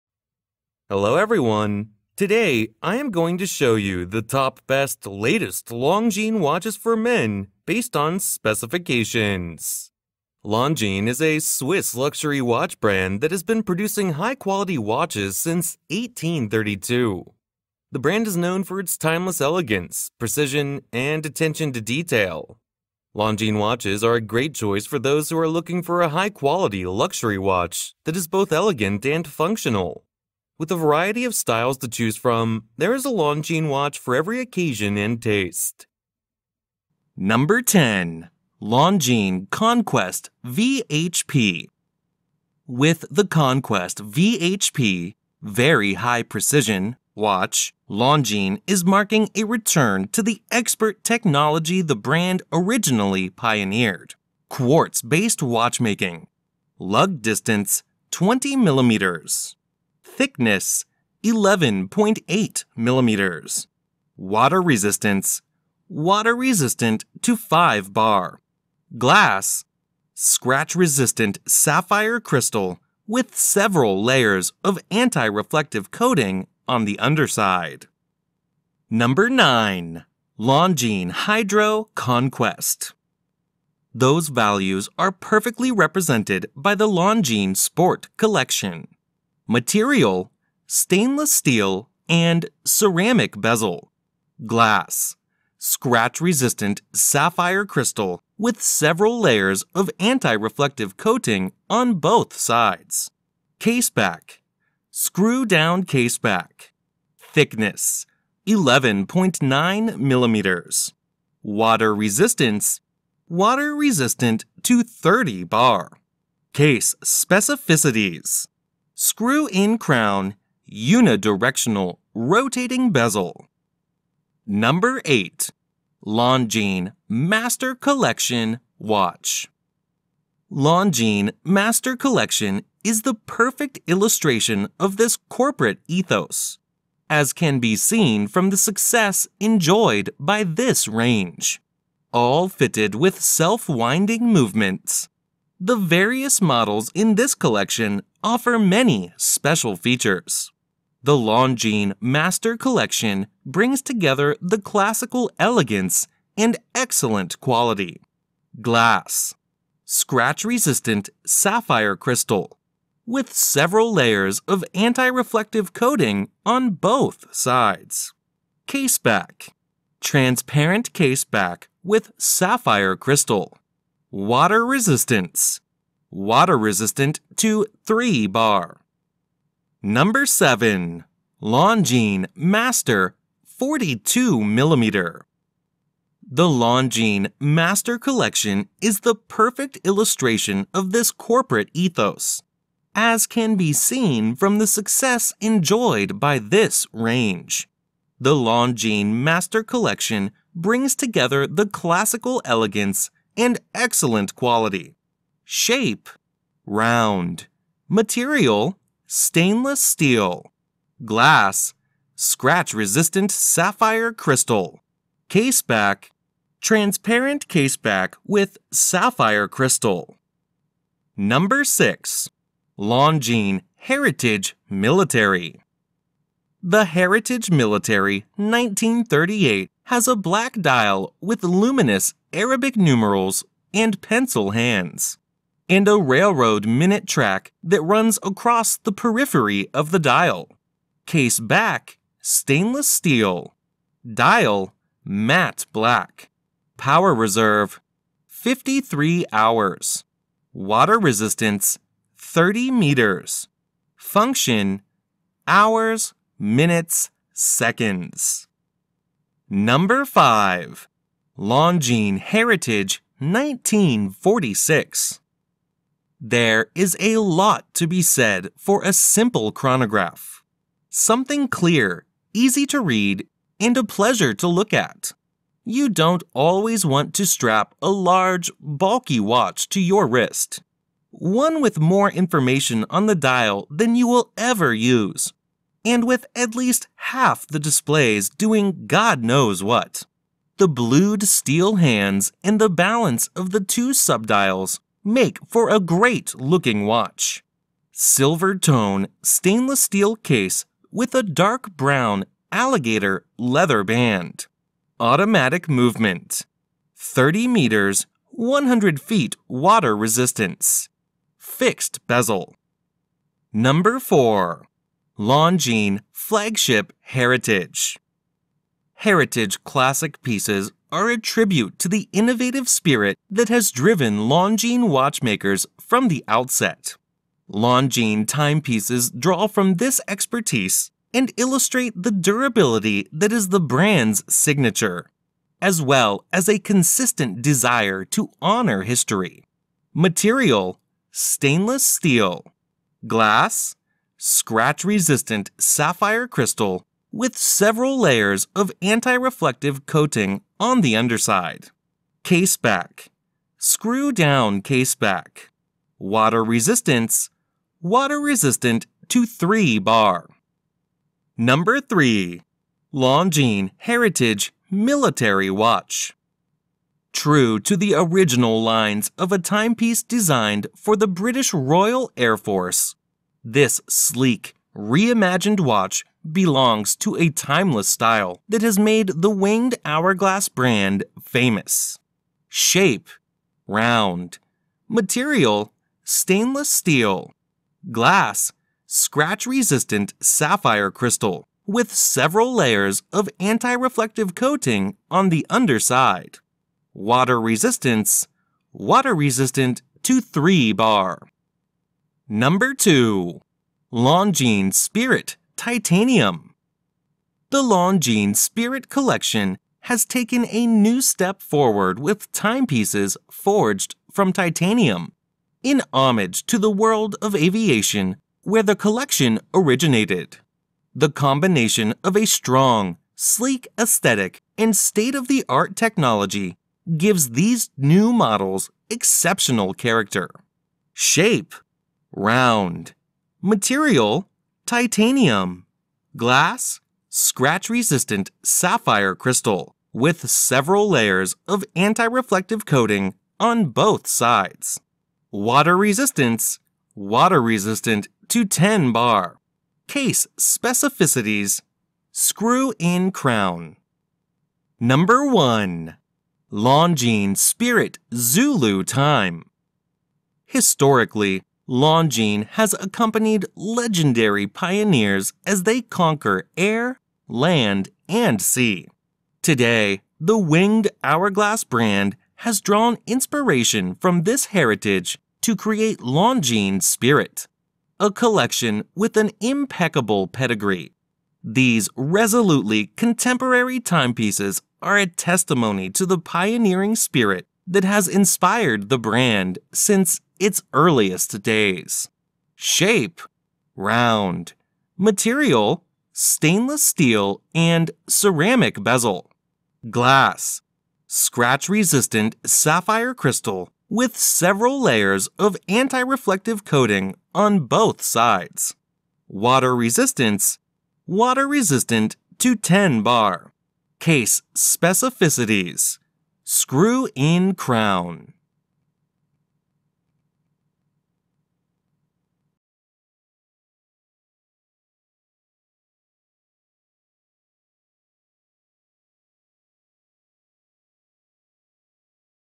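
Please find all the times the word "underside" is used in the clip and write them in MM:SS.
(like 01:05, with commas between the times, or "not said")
01:16, 05:50, 06:35.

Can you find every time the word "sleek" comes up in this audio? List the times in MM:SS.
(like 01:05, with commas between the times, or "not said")
06:13, 07:03.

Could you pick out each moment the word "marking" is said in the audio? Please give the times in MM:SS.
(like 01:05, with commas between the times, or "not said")
00:48.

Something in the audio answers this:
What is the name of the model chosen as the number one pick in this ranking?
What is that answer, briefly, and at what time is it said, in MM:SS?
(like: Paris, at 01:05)
Longines Spirit Zulu Time, at 07:36.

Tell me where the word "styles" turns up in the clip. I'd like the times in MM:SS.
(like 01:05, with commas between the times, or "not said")
00:31, 06:17.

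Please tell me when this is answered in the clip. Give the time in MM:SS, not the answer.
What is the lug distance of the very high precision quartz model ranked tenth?
00:58.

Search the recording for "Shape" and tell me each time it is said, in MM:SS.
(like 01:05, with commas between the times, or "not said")
03:25, 06:22, 07:10, 08:12.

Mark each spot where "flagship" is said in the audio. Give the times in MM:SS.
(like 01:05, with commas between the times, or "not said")
05:16.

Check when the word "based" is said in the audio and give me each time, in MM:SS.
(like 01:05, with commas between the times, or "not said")
00:07, 00:55.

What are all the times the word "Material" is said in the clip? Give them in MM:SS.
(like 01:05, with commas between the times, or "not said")
01:29, 03:27, 05:39, 06:24, 07:13, 08:14.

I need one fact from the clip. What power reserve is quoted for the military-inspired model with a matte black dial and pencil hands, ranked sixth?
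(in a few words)
53 hours.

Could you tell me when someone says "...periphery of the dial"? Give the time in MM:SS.
03:58.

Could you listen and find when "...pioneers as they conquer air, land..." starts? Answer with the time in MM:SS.
07:44.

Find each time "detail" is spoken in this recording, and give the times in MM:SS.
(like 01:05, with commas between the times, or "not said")
00:21.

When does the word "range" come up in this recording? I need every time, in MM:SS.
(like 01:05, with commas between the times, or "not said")
02:20, 03:16.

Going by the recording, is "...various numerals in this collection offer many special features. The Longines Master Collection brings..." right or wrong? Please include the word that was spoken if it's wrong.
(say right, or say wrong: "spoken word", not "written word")
wrong: "models", not "numerals".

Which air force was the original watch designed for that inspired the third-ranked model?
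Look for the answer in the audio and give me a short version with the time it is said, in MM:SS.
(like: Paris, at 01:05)
British Royal Air Force, at 06:11.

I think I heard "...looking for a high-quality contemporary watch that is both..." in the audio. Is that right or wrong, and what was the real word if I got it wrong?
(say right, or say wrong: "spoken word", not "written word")
wrong: "luxury", not "contemporary".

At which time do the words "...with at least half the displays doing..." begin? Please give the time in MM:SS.
04:46.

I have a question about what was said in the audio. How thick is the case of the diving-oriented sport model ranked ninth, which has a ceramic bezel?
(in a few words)
11.9 millimeters.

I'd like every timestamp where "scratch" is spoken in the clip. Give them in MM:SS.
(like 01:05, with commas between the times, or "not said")
01:10, 01:35, 02:39, 03:32, 05:44, 06:28, 07:17, 08:21.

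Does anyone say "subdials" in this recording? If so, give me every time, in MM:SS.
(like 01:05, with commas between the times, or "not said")
04:53.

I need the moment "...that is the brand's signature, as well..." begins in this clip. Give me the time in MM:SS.
05:33.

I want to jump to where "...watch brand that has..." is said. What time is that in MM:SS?
00:12.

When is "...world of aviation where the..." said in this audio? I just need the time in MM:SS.
06:56.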